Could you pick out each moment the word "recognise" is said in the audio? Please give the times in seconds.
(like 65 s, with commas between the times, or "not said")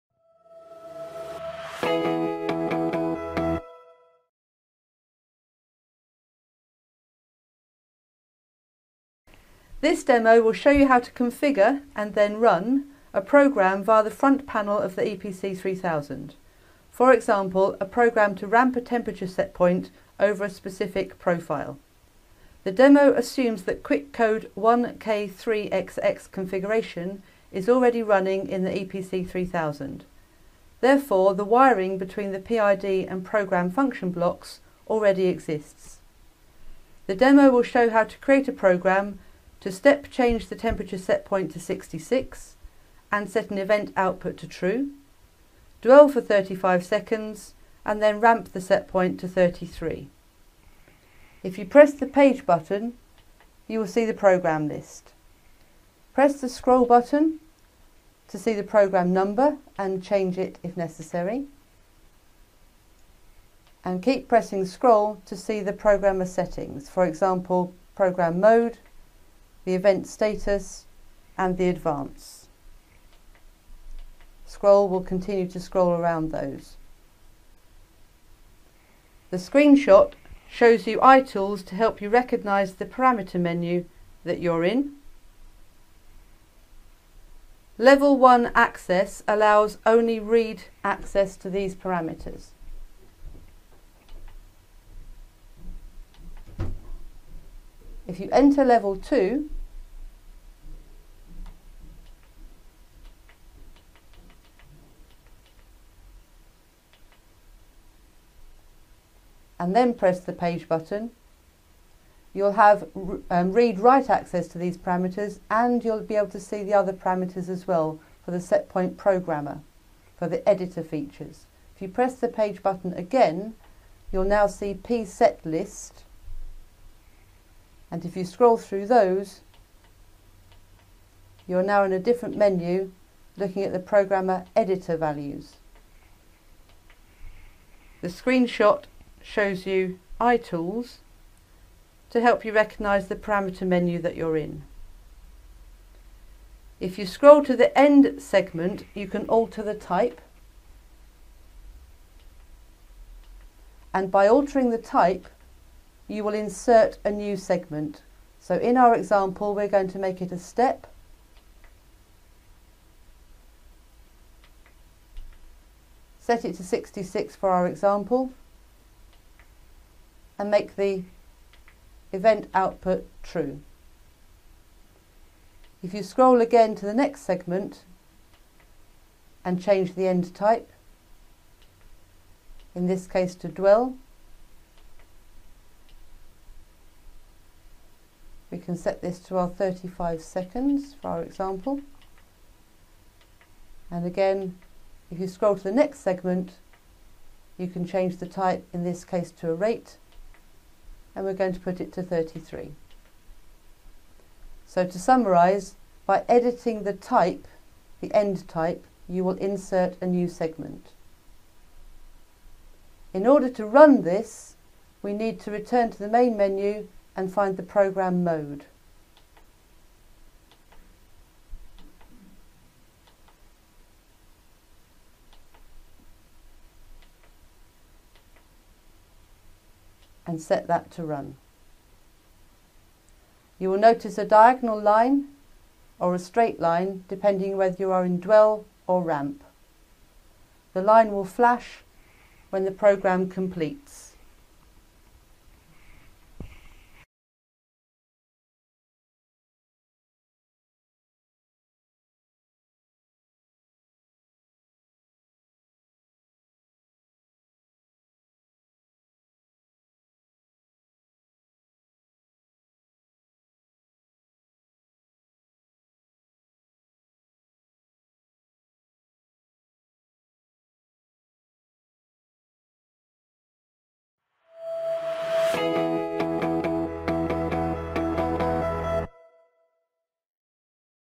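82 s, 142 s.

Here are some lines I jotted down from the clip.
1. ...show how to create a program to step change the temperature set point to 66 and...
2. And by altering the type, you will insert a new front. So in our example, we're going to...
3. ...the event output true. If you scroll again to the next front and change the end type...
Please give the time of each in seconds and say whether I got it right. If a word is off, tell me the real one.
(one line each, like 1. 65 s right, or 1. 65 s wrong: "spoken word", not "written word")
1. 37 s right
2. 153 s wrong: "segment", not "front"
3. 170 s wrong: "segment", not "front".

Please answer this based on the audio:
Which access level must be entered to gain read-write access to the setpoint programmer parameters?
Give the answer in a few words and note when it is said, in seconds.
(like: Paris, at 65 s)
Level 2, at 98 s.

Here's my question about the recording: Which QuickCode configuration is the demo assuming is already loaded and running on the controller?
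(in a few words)
1K3XX.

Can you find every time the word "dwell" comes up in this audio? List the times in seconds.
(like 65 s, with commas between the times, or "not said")
45 s, 183 s, 238 s.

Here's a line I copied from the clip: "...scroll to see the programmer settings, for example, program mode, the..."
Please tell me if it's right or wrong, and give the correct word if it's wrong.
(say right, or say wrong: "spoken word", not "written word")
right.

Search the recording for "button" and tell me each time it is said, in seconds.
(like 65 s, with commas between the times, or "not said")
52 s, 56 s, 110 s, 122 s.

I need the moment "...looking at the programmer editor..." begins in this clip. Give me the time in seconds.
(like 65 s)
133 s.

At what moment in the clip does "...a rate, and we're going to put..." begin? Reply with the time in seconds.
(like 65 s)
199 s.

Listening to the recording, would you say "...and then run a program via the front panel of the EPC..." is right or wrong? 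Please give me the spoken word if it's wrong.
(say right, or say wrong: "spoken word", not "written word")
right.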